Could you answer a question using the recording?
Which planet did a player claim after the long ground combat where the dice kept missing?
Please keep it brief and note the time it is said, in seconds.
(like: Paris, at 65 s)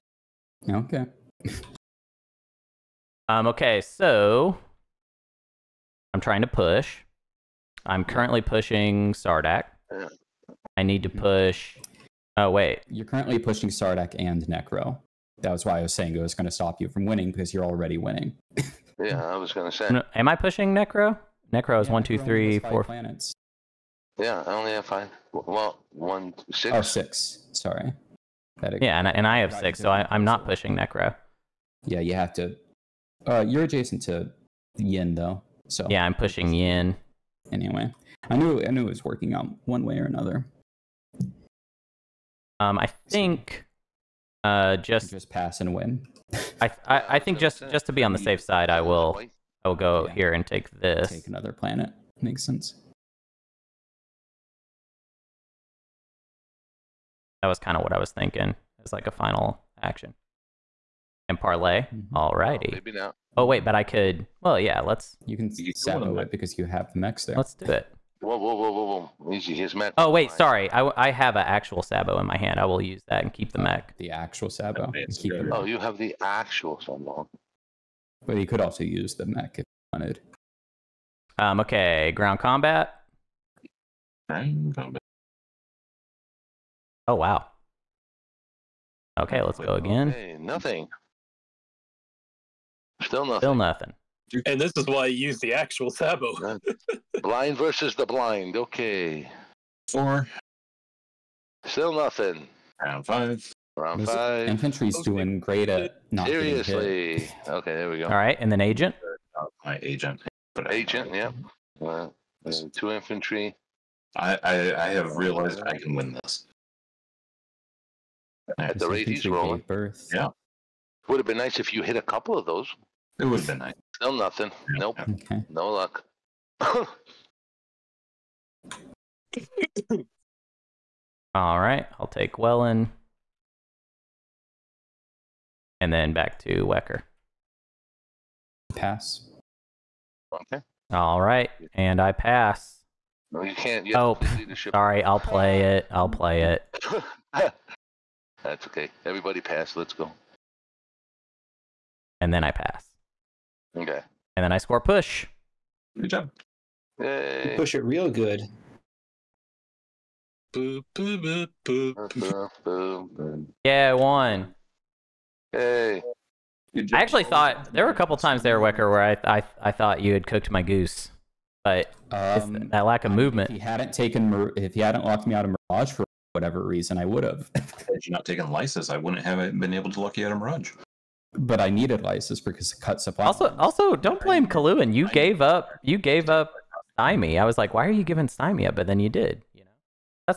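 Wellon, at 132 s.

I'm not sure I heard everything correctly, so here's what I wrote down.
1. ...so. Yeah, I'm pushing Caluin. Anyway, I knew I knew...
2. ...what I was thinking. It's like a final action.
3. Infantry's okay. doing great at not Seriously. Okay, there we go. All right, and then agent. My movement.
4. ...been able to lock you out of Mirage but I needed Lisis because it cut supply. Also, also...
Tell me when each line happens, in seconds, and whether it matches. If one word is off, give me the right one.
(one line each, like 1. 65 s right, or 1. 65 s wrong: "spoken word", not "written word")
1. 35 s wrong: "Yin", not "Caluin"
2. 57 s right
3. 104 s wrong: "agent", not "movement"
4. 179 s right.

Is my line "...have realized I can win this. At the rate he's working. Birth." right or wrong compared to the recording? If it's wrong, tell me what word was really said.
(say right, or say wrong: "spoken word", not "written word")
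wrong: "rolling", not "working".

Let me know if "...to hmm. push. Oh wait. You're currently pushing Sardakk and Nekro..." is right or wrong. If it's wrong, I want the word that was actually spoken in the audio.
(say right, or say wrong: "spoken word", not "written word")
right.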